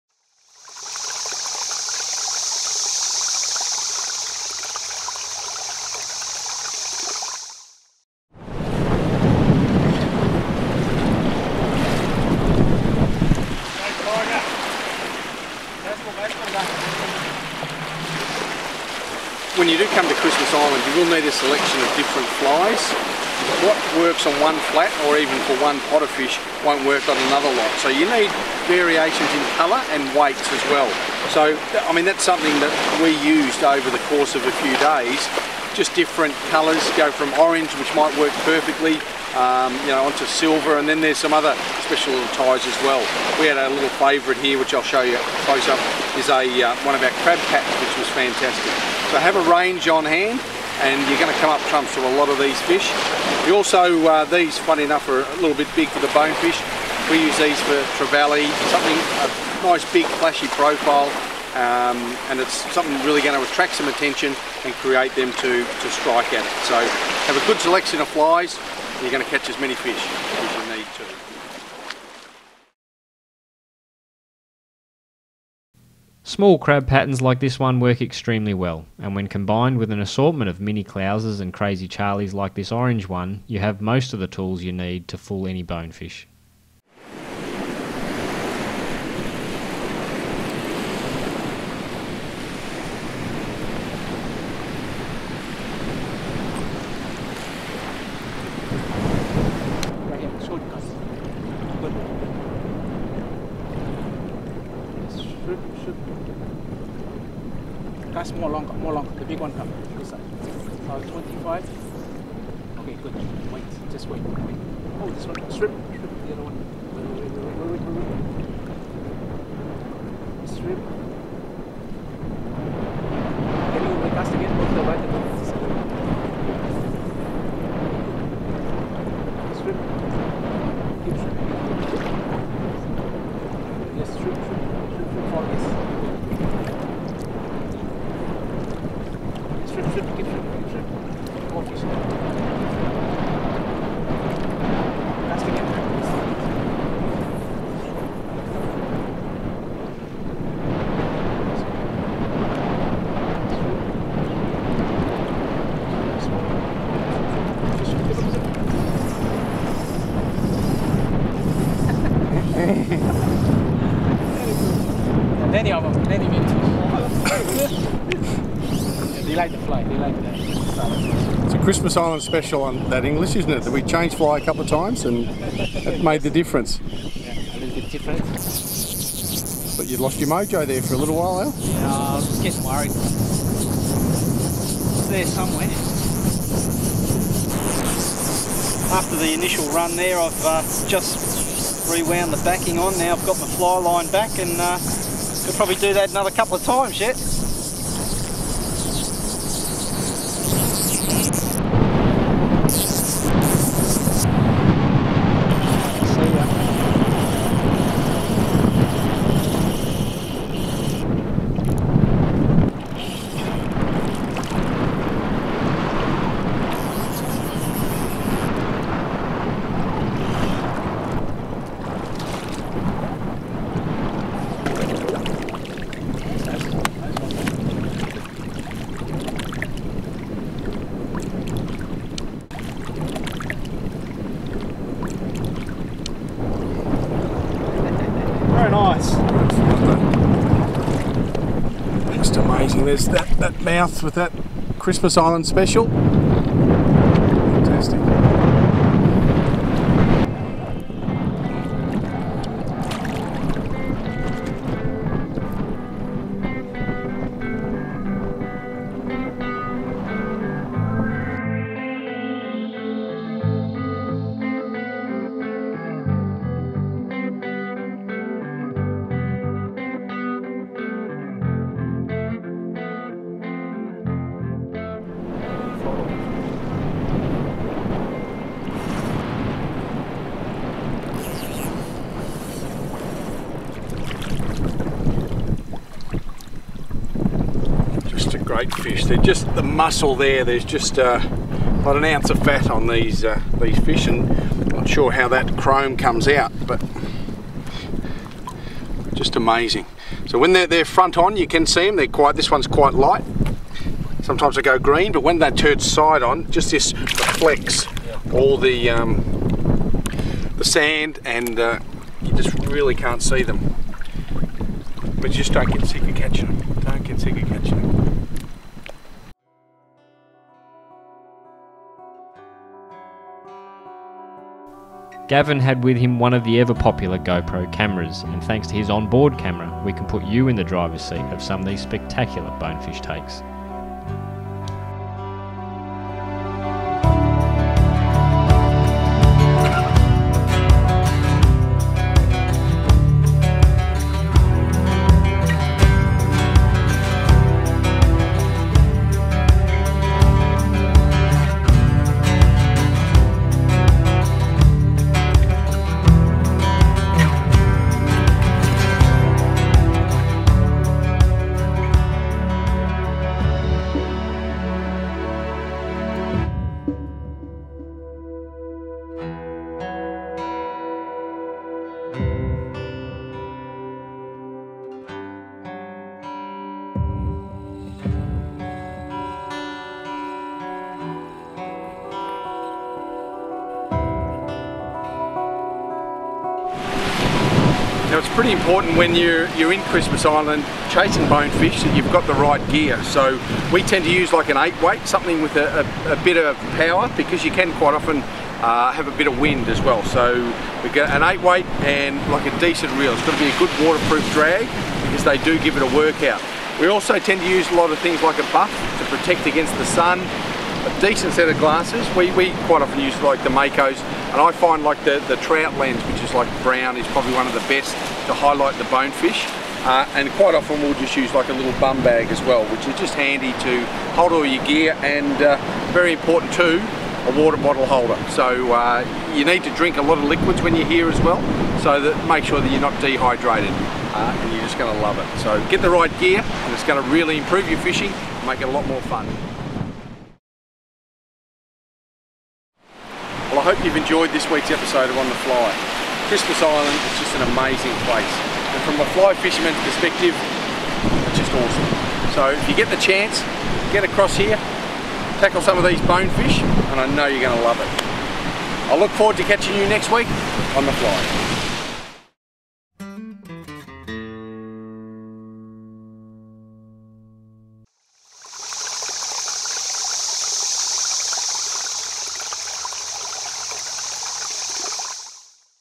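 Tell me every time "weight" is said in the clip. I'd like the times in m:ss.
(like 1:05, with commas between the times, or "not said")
0:30, 6:34, 6:41.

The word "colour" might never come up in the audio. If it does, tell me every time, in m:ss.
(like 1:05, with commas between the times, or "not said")
0:29, 0:36.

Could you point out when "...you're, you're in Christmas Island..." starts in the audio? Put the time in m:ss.
6:29.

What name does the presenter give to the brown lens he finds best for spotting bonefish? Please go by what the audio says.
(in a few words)
Trout lens.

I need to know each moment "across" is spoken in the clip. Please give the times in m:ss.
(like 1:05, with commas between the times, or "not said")
7:34.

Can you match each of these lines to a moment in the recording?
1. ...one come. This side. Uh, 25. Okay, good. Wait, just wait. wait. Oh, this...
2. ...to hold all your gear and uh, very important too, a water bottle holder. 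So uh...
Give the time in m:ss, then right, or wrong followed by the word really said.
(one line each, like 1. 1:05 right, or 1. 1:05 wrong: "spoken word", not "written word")
1. 1:49 right
2. 7:03 right.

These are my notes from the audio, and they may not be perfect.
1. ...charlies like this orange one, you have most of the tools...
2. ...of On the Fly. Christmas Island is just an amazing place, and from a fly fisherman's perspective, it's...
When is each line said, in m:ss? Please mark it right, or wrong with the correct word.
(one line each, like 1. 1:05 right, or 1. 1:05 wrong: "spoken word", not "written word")
1. 1:21 right
2. 7:25 right.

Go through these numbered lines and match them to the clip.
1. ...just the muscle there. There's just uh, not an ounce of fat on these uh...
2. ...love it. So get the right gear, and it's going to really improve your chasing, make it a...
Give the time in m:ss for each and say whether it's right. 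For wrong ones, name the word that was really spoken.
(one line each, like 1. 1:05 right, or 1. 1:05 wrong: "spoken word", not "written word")
1. 4:49 right
2. 7:15 wrong: "fishing", not "chasing".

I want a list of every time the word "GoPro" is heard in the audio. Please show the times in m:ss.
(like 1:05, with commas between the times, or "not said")
5:27.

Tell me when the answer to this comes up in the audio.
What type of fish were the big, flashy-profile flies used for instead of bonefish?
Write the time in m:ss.
0:57.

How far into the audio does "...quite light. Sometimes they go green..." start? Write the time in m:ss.
5:02.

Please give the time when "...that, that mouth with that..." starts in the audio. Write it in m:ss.
4:03.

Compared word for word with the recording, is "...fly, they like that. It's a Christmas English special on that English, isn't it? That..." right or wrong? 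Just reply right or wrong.
wrong.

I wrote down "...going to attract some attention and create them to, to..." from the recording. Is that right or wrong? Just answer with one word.
right.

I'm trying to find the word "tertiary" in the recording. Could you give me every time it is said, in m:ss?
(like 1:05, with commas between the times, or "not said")
not said.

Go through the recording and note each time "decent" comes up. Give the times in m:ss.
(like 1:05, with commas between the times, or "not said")
6:42, 6:51.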